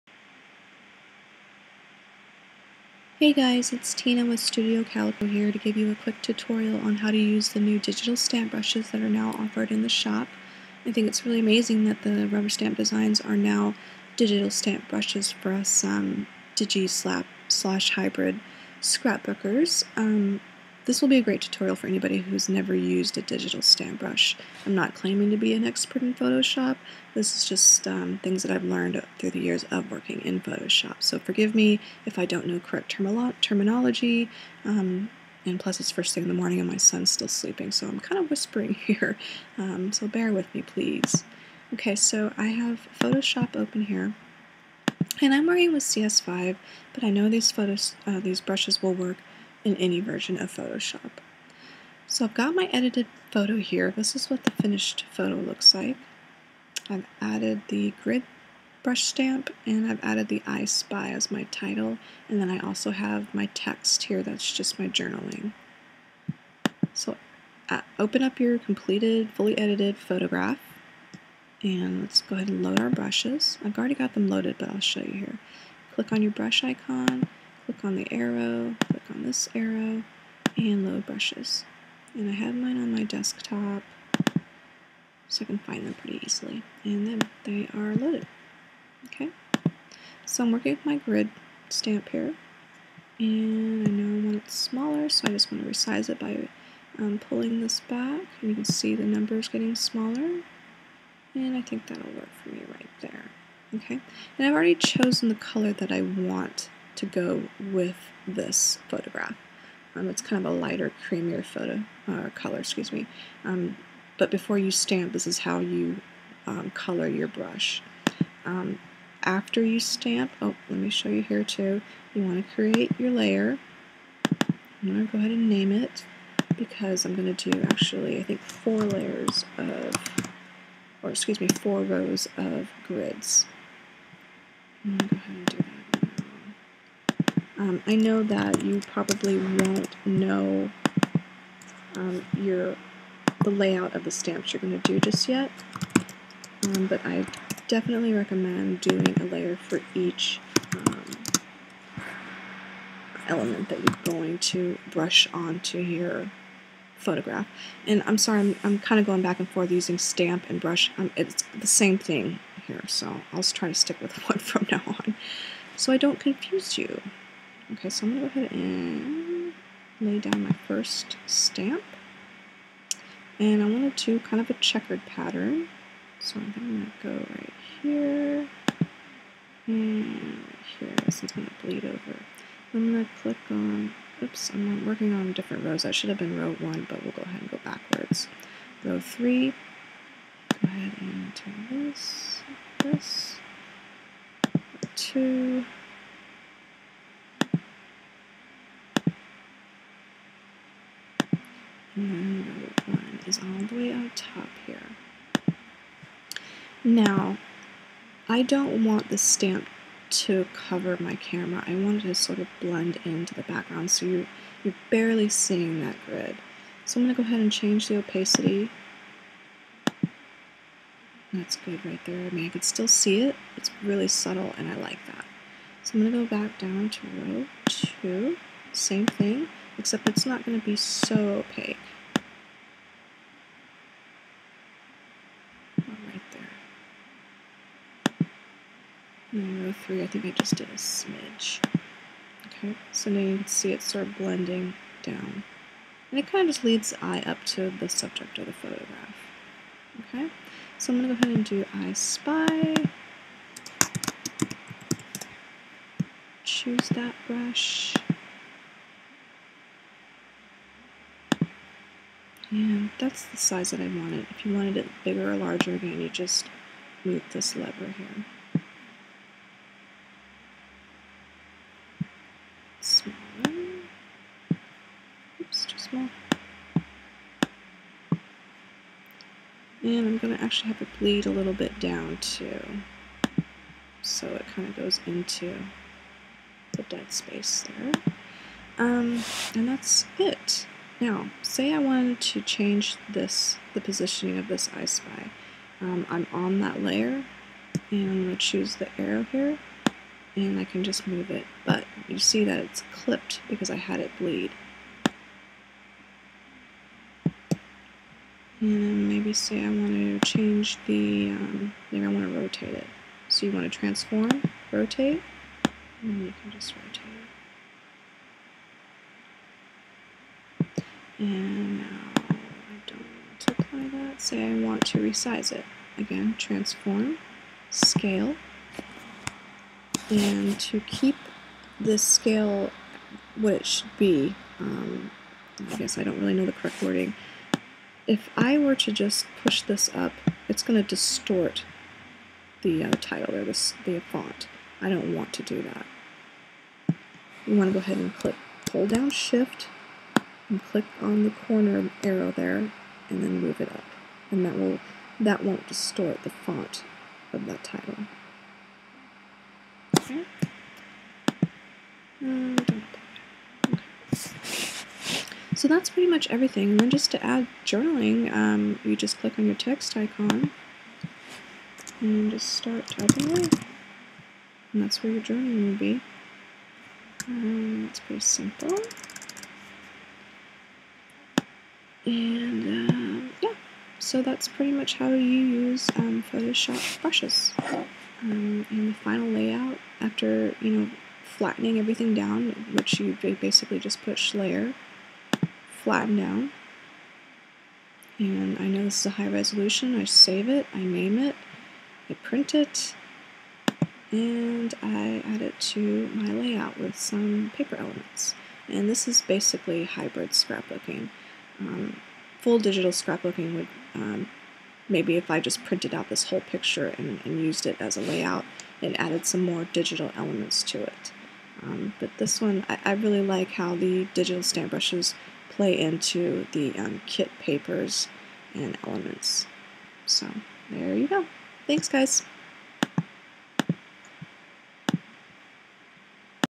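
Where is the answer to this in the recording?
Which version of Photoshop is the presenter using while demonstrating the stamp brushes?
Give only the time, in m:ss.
0:45.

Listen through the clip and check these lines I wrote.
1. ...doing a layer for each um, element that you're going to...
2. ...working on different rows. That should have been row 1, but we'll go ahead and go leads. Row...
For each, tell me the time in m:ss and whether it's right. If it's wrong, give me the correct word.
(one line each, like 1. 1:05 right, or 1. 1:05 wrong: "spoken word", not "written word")
1. 2:28 right
2. 3:04 wrong: "backwards", not "leads".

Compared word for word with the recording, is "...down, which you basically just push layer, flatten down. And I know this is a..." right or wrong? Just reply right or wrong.
right.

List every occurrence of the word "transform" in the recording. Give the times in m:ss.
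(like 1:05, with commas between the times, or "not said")
5:13, 5:26.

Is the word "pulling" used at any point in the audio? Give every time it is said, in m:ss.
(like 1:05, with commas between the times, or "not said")
1:37.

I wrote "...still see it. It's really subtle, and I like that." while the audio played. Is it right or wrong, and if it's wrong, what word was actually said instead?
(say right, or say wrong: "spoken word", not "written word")
right.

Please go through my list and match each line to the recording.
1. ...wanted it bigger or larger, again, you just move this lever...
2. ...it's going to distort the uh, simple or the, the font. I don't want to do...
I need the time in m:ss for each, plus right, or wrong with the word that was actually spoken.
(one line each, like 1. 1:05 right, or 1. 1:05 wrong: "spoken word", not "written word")
1. 4:24 right
2. 5:40 wrong: "title", not "simple".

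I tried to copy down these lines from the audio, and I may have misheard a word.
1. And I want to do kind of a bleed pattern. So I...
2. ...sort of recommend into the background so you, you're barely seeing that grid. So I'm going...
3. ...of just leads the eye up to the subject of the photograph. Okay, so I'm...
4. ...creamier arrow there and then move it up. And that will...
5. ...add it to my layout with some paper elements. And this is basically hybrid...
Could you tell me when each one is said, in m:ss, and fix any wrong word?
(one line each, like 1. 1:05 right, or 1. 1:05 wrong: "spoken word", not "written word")
1. 2:53 wrong: "checkered", not "bleed"
2. 3:32 wrong: "blend", not "recommend"
3. 4:06 right
4. 5:51 wrong: "corner", not "creamier"
5. 6:45 right.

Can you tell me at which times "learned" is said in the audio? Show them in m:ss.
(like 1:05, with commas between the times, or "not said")
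0:28.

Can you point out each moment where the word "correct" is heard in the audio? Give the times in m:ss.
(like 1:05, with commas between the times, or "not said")
0:32, 5:36.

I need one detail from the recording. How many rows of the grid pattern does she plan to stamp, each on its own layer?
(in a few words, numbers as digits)
4.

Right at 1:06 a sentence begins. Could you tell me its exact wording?
So uh, open up your completed fully edited photograph and let's go ahead and load our brushes.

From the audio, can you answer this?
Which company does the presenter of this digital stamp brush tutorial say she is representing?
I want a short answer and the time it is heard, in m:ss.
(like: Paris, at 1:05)
Studio Calico, at 0:04.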